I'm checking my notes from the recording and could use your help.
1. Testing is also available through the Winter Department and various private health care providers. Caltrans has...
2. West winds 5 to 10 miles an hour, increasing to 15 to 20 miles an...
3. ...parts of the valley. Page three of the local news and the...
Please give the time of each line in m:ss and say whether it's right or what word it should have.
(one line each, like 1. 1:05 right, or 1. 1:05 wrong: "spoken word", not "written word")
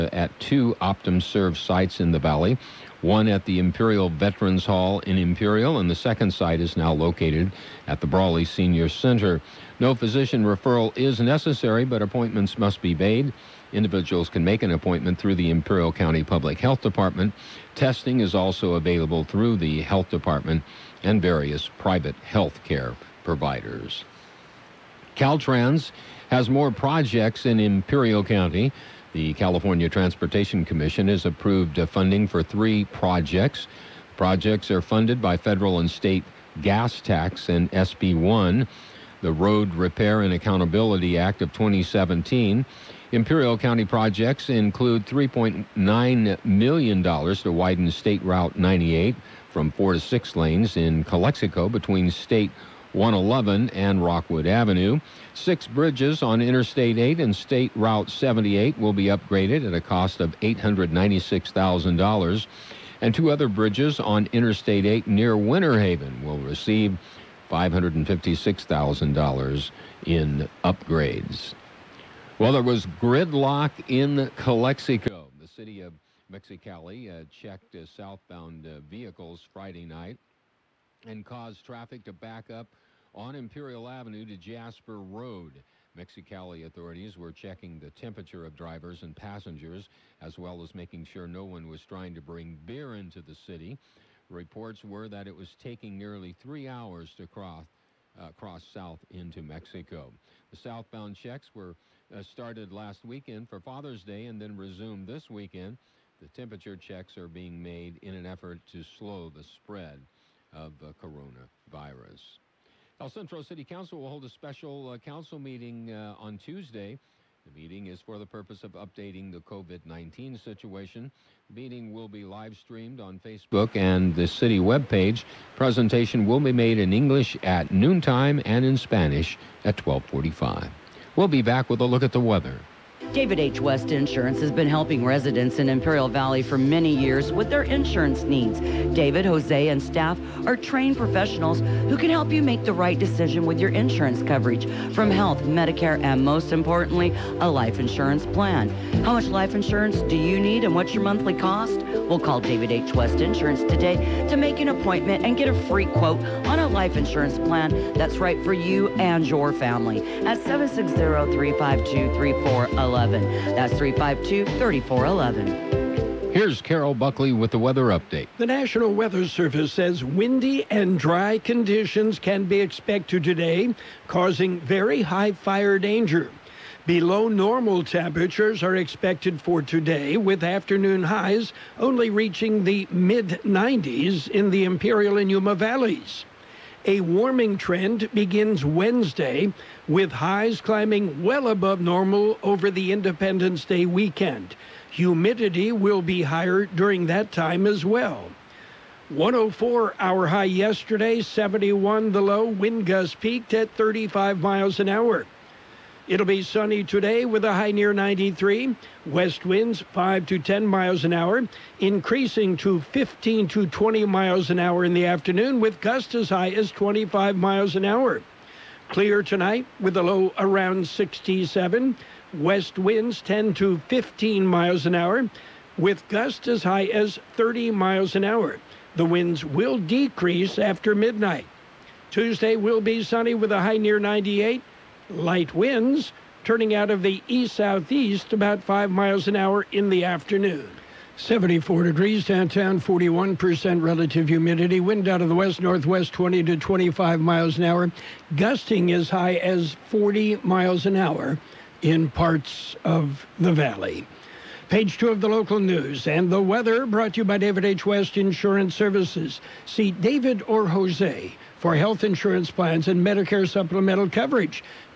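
1. 0:17 wrong: "Health", not "Winter"
2. 3:29 right
3. 4:12 wrong: "two", not "three".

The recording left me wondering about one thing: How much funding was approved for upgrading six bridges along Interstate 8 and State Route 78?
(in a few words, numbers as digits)
$896,000.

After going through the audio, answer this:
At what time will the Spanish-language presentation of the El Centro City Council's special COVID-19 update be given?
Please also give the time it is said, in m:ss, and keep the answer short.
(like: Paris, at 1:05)
12:45, at 2:09.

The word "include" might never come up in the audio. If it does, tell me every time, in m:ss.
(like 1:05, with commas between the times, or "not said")
0:44.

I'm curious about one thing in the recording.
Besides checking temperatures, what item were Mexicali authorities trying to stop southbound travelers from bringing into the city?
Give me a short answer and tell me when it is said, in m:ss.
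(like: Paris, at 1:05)
Beer, at 1:32.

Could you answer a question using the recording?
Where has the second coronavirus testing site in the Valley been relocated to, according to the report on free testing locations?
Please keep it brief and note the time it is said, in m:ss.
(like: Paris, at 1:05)
Brawley Senior Center, at 0:08.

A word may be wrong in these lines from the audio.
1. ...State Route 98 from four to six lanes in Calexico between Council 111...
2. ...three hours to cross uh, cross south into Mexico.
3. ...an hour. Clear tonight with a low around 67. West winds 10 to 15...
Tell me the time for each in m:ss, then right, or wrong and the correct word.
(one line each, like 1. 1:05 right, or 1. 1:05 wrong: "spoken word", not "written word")
1. 0:47 wrong: "State", not "Council"
2. 1:36 right
3. 3:37 right.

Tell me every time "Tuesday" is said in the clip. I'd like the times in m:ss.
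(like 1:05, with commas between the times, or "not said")
1:56, 3:52.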